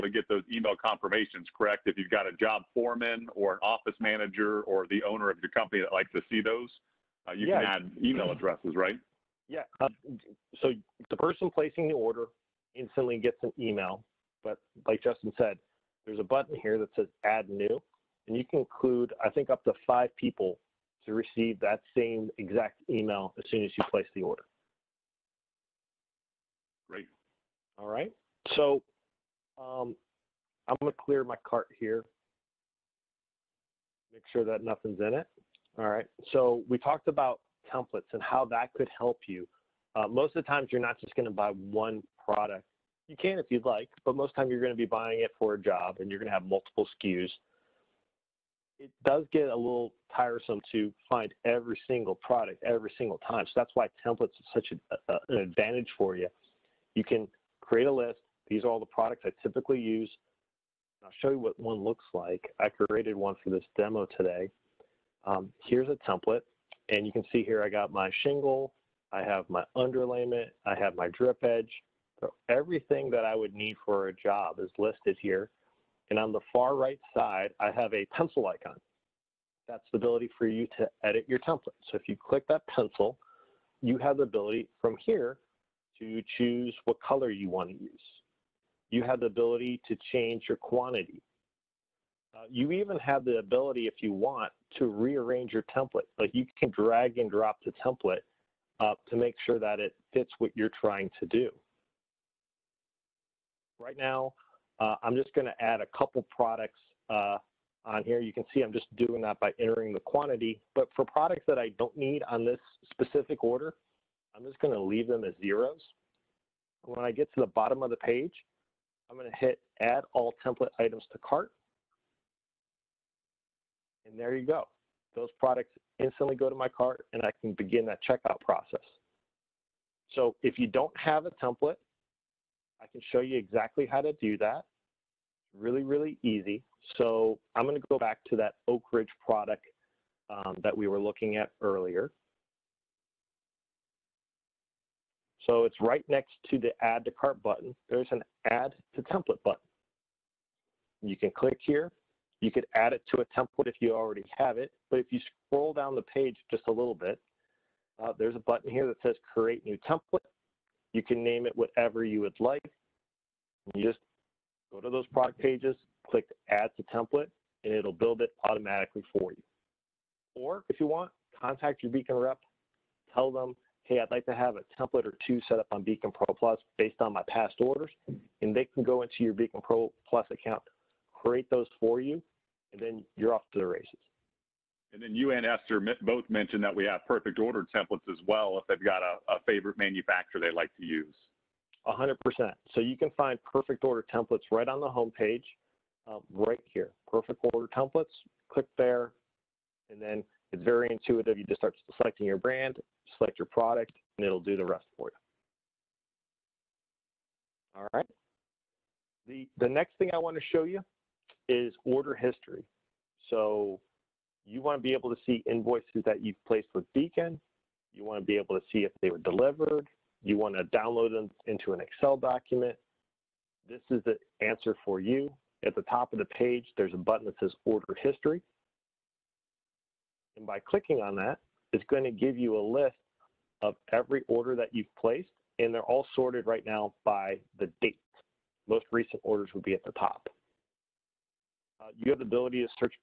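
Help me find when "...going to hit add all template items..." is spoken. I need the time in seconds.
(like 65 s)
119 s.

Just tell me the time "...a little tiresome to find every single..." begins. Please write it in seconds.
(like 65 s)
49 s.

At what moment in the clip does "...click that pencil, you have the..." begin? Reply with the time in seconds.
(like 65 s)
82 s.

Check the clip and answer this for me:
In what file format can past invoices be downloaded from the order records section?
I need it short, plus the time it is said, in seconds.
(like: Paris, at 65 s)
Excel, at 221 s.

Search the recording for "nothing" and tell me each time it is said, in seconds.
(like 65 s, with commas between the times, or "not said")
34 s.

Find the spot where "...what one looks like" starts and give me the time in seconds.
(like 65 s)
61 s.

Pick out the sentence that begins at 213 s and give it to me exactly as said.
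So you want to be able to see invoices that you've placed with Beacon.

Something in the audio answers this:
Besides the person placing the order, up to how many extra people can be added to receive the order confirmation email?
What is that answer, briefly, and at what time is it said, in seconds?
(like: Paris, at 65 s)
5, at 19 s.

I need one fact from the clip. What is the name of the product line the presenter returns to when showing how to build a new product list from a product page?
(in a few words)
Oak Ridge.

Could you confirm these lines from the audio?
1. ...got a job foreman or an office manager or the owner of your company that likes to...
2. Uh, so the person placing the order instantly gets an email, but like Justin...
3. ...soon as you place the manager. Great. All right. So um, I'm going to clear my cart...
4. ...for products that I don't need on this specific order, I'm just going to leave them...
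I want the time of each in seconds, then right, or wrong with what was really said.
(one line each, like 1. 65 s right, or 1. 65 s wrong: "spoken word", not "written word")
1. 2 s right
2. 9 s right
3. 23 s wrong: "order", not "manager"
4. 110 s right.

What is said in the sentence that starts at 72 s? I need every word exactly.
So everything that I would need for a job is listed here.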